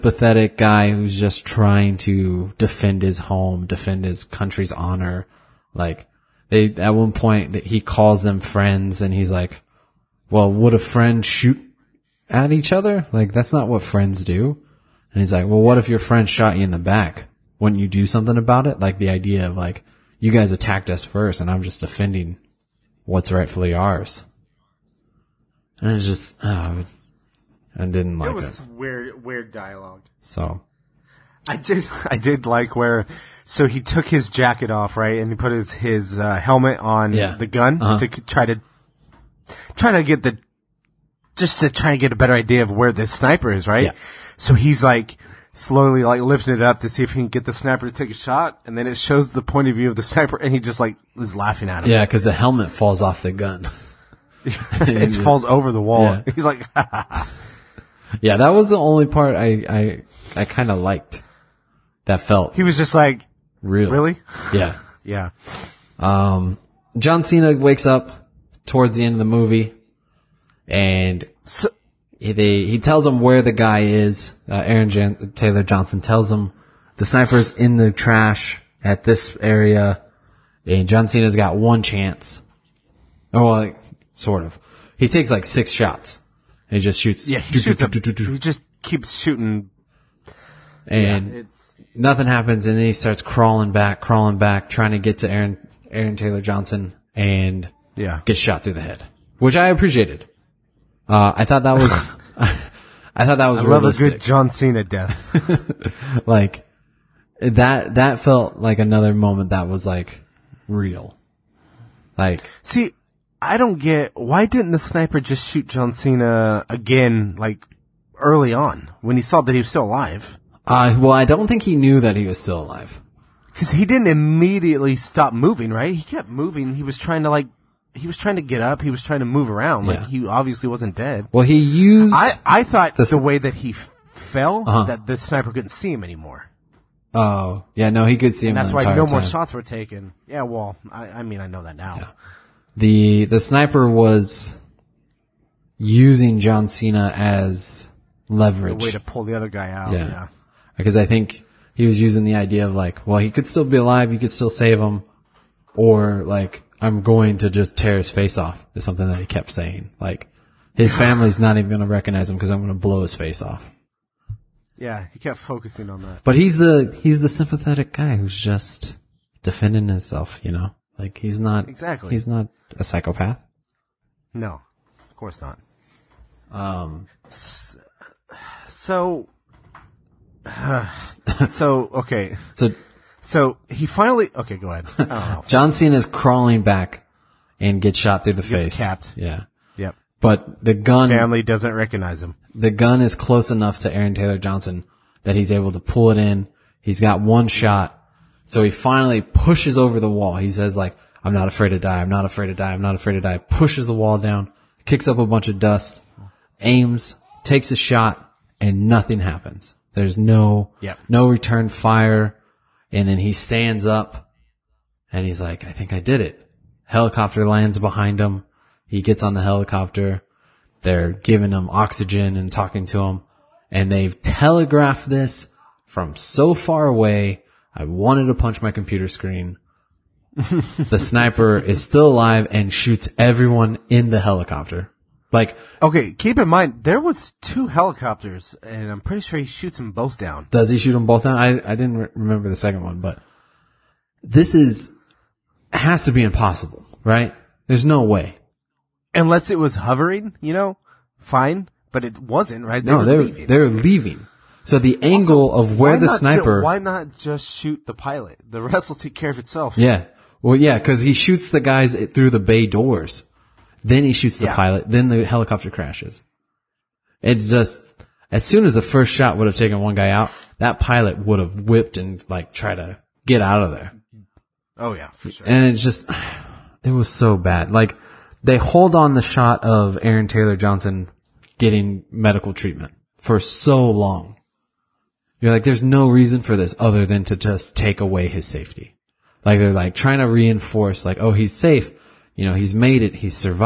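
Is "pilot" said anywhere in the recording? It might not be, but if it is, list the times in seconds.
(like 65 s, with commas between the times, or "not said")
257 s, 264 s, 270 s.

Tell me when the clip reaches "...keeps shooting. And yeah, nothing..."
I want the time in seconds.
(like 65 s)
88 s.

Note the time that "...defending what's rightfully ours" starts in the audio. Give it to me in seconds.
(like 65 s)
21 s.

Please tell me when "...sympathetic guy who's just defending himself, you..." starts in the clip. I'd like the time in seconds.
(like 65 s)
167 s.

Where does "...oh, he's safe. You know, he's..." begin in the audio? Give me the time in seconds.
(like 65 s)
291 s.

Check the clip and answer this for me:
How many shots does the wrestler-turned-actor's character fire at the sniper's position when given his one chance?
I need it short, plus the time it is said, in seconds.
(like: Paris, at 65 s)
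6, at 85 s.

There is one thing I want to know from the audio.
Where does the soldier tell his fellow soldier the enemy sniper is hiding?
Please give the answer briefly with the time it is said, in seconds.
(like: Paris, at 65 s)
in the trash, at 77 s.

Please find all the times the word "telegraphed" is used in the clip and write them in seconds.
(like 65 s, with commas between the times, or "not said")
224 s.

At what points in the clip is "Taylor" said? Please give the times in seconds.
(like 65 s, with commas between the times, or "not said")
75 s, 96 s, 194 s, 280 s.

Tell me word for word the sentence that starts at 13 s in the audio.
Like that's not what friends do.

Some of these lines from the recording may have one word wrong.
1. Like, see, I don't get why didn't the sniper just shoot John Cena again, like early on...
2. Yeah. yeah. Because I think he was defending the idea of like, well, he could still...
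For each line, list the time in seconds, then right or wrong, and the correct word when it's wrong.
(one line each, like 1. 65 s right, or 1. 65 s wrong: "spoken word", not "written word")
1. 112 s right
2. 149 s wrong: "using", not "defending".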